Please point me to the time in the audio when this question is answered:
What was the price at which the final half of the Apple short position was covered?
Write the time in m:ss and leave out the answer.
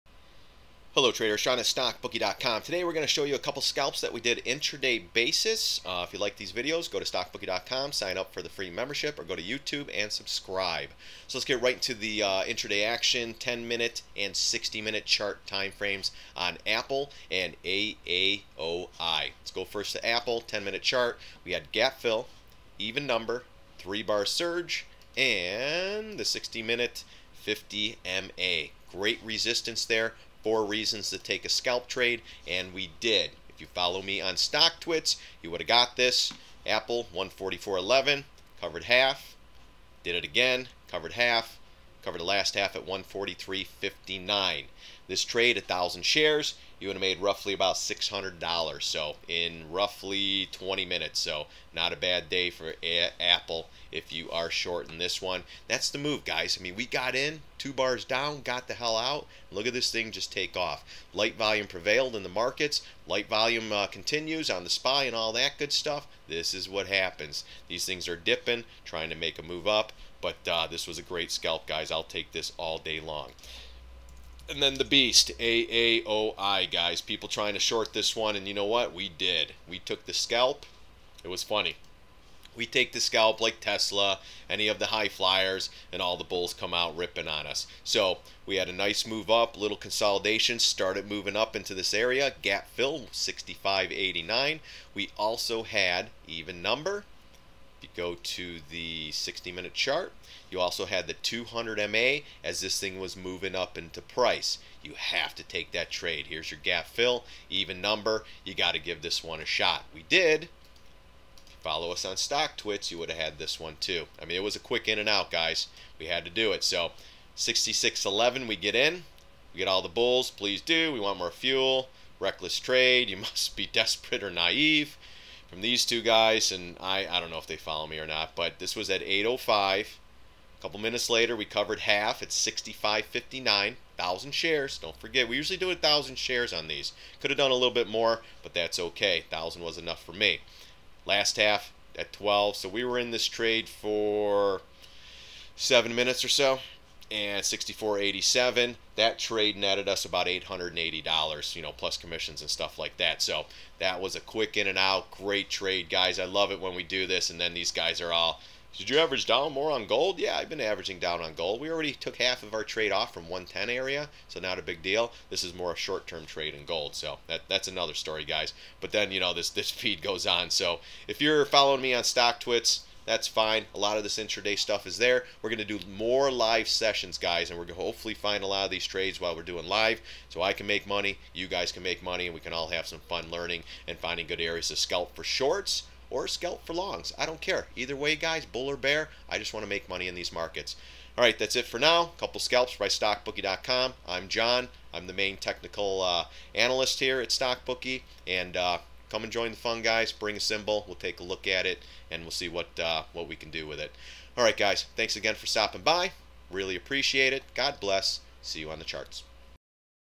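0:42.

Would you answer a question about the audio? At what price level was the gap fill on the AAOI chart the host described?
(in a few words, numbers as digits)
65.89.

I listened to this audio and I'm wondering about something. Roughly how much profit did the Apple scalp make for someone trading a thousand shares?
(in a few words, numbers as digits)
$600.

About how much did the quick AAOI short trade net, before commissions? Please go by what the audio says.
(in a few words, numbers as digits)
$880.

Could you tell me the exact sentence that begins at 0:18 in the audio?
Let's go first to Apple, 10 minute chart.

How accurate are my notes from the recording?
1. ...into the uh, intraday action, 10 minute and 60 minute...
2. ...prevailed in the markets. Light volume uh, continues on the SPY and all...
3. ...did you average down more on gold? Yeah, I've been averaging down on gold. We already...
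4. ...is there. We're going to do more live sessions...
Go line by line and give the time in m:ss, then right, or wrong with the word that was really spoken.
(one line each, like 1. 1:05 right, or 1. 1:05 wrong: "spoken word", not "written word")
1. 0:11 right
2. 1:01 right
3. 2:38 right
4. 2:54 right.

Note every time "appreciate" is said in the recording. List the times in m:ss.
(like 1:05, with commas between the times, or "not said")
3:26.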